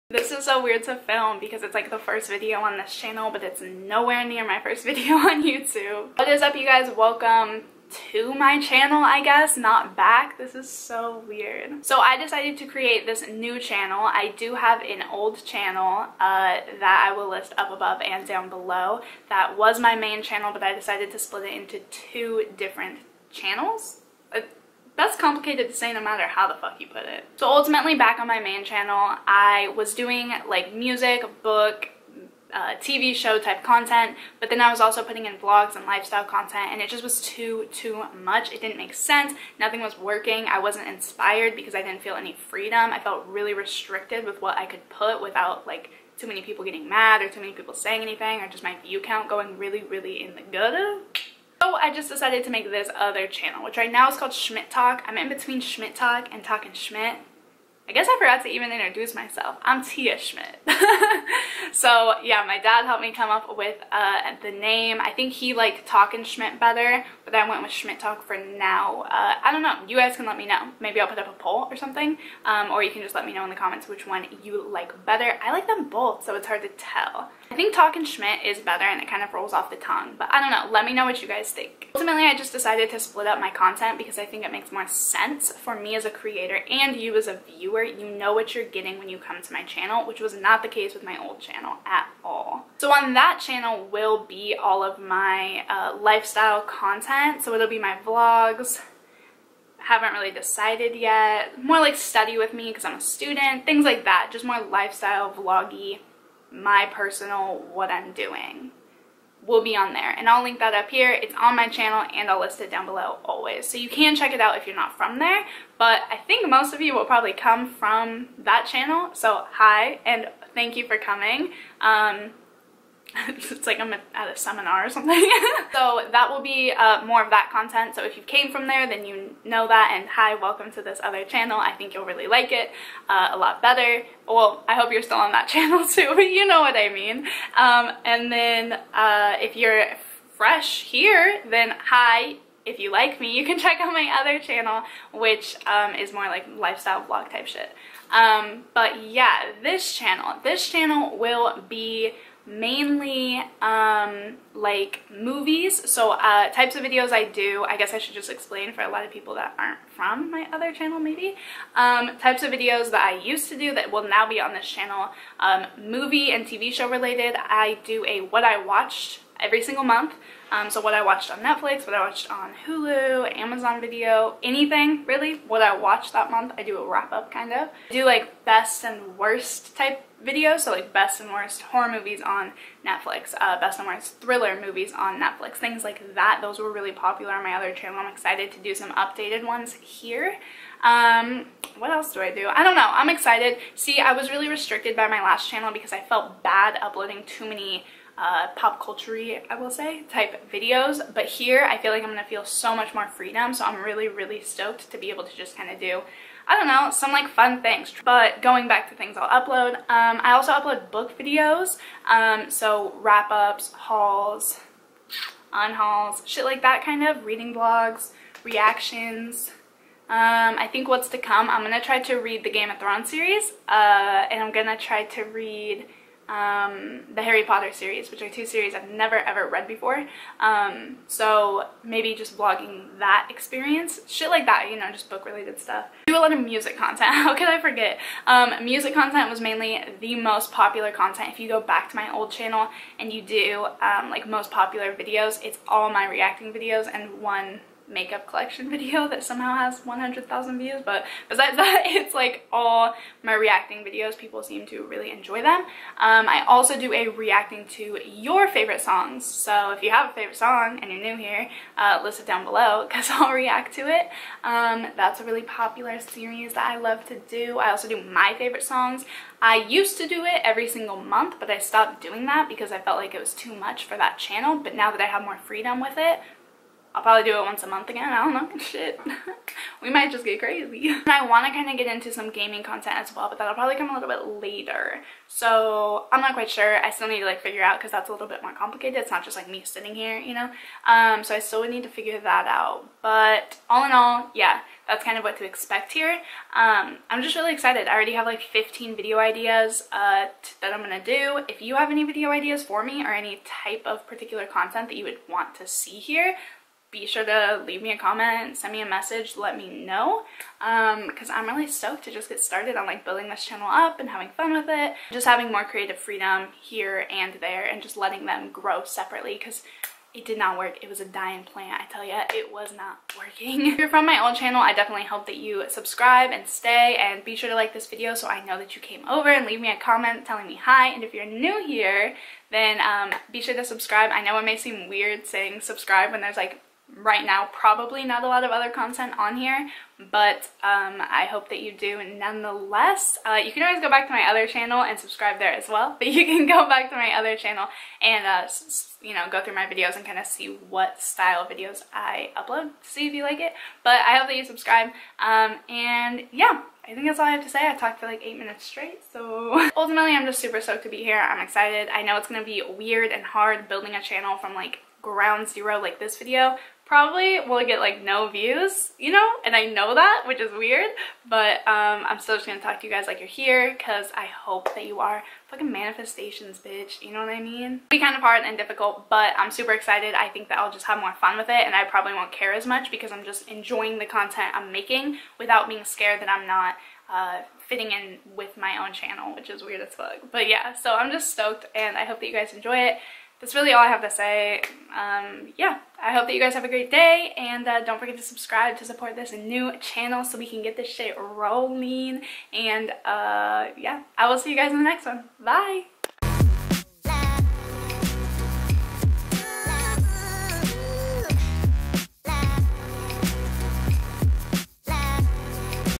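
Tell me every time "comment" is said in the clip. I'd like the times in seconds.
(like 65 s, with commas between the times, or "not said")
73 s, 307 s, 329 s.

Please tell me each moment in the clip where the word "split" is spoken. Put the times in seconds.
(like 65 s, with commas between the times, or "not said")
21 s, 82 s.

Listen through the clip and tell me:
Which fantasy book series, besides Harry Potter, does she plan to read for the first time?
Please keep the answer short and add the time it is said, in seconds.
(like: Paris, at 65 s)
Game of Thrones, at 222 s.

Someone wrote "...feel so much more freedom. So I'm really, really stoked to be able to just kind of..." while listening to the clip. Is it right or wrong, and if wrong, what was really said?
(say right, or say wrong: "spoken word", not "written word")
right.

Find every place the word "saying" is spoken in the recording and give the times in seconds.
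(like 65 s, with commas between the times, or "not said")
47 s, 335 s.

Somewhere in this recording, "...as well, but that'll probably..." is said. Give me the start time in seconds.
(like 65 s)
282 s.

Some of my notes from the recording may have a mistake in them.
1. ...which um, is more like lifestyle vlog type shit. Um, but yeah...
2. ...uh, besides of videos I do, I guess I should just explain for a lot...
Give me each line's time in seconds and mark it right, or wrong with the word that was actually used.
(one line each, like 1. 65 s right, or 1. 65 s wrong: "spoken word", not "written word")
1. 145 s right
2. 156 s wrong: "types", not "besides".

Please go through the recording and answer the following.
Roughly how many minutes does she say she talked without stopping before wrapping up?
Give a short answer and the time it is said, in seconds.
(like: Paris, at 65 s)
8, at 358 s.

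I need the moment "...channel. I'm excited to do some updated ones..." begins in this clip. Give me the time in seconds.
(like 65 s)
187 s.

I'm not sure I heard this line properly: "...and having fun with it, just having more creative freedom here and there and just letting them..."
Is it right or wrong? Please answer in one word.
right.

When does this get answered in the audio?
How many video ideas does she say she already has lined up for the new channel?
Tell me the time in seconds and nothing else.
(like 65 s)
298 s.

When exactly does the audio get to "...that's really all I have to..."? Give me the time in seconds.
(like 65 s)
393 s.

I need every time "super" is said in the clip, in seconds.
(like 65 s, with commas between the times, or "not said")
360 s, 379 s.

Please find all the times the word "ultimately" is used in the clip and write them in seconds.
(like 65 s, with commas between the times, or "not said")
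27 s, 81 s, 359 s.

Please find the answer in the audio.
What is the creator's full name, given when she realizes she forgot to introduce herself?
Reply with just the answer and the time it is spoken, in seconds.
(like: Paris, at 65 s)
Tia Schmidt, at 59 s.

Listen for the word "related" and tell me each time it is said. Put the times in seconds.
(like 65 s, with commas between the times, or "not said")
166 s, 235 s.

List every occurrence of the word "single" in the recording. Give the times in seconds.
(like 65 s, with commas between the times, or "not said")
169 s, 270 s.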